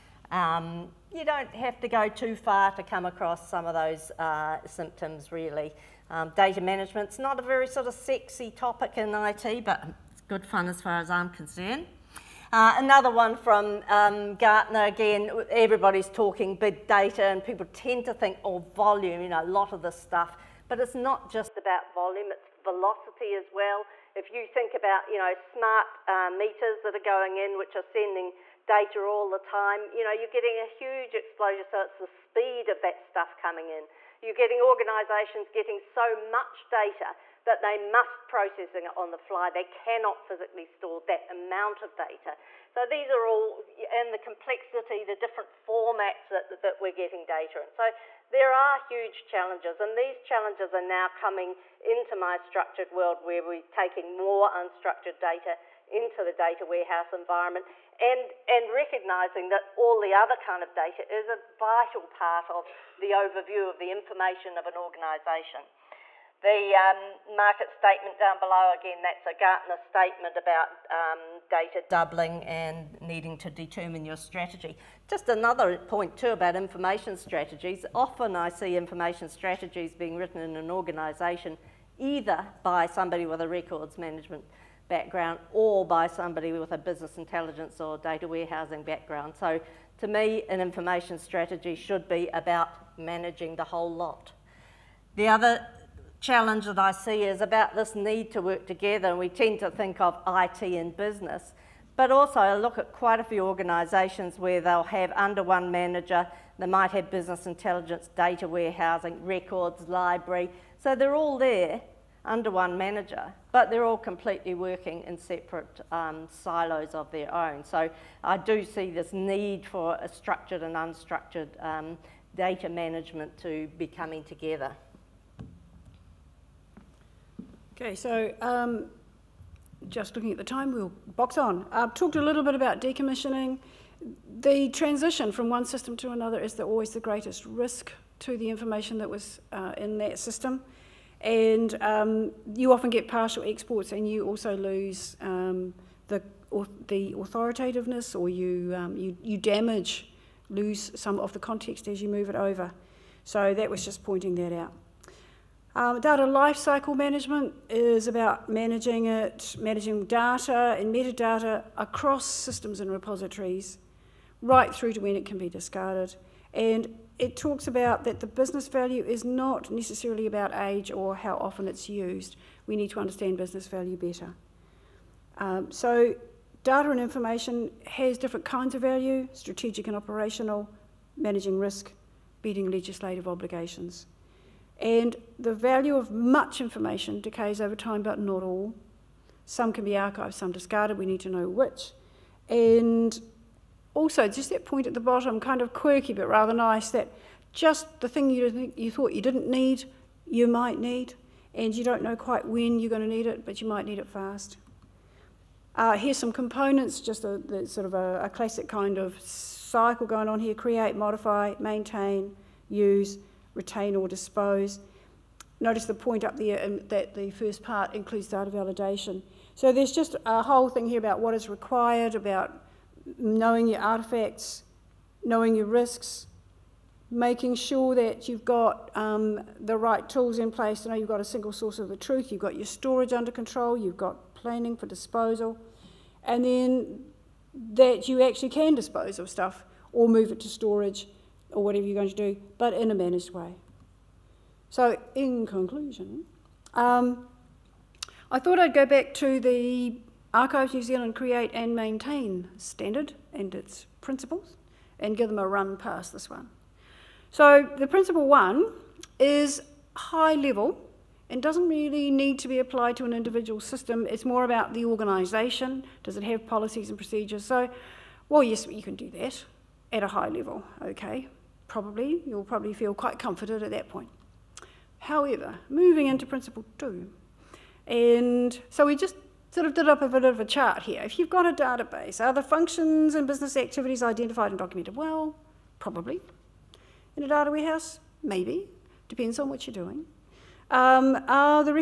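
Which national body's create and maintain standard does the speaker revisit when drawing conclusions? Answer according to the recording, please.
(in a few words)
Archives New Zealand.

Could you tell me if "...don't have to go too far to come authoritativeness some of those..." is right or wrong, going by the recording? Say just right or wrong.
wrong.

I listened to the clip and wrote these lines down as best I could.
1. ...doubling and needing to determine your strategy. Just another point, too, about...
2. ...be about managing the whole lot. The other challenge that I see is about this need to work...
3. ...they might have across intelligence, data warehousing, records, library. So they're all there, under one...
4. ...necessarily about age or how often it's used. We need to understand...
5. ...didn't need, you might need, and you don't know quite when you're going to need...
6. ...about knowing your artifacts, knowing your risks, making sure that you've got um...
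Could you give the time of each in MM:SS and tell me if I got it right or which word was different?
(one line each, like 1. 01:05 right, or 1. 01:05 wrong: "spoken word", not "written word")
1. 01:11 right
2. 01:32 right
3. 01:46 wrong: "business", not "across"
4. 02:49 right
5. 03:19 right
6. 03:42 right.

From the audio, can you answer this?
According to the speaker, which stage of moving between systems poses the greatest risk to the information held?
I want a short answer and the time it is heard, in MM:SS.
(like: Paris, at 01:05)
the transition, at 02:14.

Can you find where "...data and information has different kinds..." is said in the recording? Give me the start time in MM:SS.
02:56.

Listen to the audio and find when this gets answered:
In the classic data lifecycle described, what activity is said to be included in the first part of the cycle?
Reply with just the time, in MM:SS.
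03:38.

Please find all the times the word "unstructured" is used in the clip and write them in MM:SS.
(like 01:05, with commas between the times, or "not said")
00:54, 02:00.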